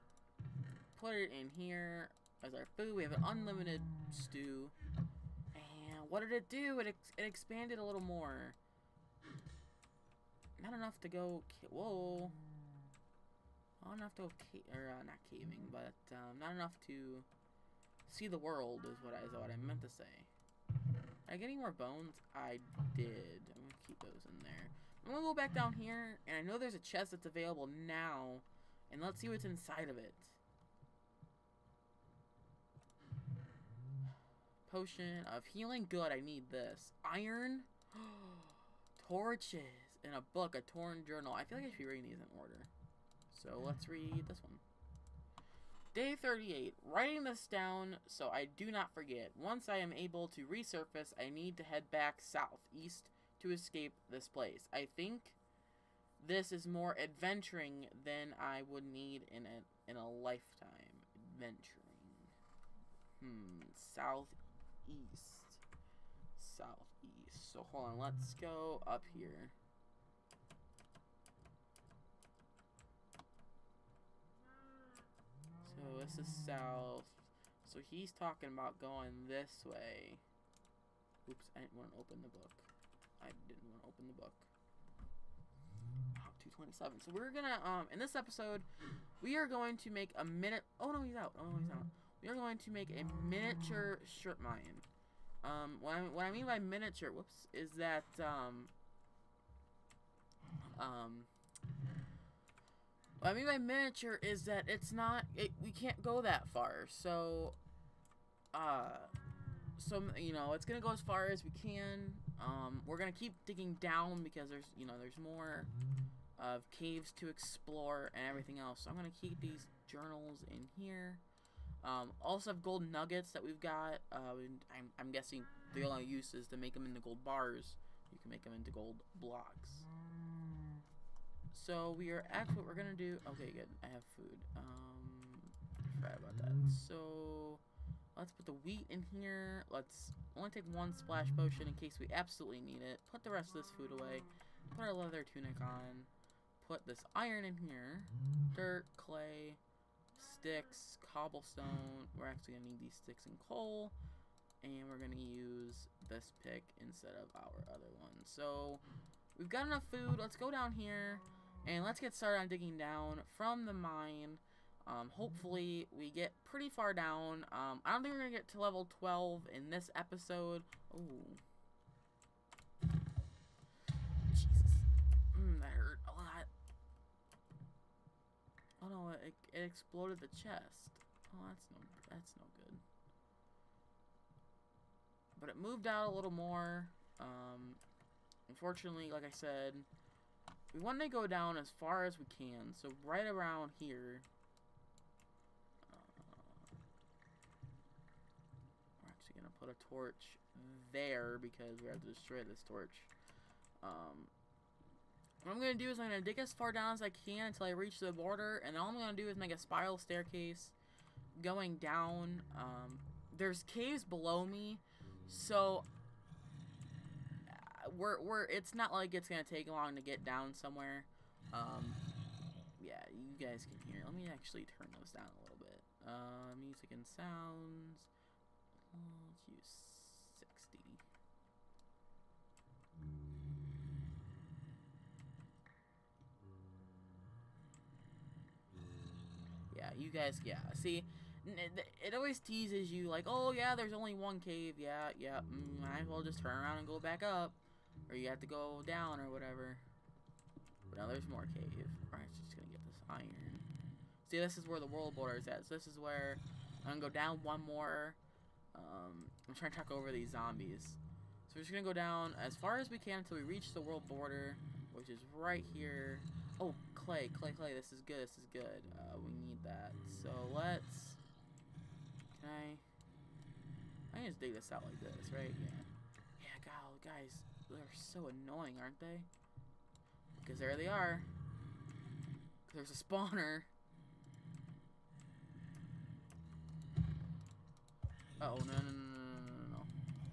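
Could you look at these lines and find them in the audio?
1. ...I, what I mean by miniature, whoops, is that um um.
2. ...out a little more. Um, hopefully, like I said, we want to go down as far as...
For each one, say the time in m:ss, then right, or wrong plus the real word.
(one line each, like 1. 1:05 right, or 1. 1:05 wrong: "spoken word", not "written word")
1. 1:35 right
2. 3:05 wrong: "unfortunately", not "hopefully".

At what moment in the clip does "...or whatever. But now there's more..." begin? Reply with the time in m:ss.
4:09.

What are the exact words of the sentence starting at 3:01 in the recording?
Oh, that's no, that's no good.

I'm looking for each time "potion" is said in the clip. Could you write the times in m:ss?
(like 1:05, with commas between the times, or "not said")
0:34, 2:21.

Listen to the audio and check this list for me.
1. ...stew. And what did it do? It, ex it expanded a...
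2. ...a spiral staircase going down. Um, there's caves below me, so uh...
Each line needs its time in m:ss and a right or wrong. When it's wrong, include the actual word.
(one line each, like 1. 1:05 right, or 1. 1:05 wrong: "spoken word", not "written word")
1. 0:04 right
2. 3:29 right.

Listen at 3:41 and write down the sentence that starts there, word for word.
Um, yeah, you guys can hear.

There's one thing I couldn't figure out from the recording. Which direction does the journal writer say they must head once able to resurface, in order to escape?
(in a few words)
South, east.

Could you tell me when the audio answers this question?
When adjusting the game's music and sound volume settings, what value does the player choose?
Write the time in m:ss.
3:50.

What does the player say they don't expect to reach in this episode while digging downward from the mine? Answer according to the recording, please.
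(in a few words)
Level 12.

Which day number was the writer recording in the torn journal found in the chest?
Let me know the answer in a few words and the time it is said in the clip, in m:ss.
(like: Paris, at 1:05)
38, at 0:45.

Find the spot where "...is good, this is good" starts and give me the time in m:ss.
4:27.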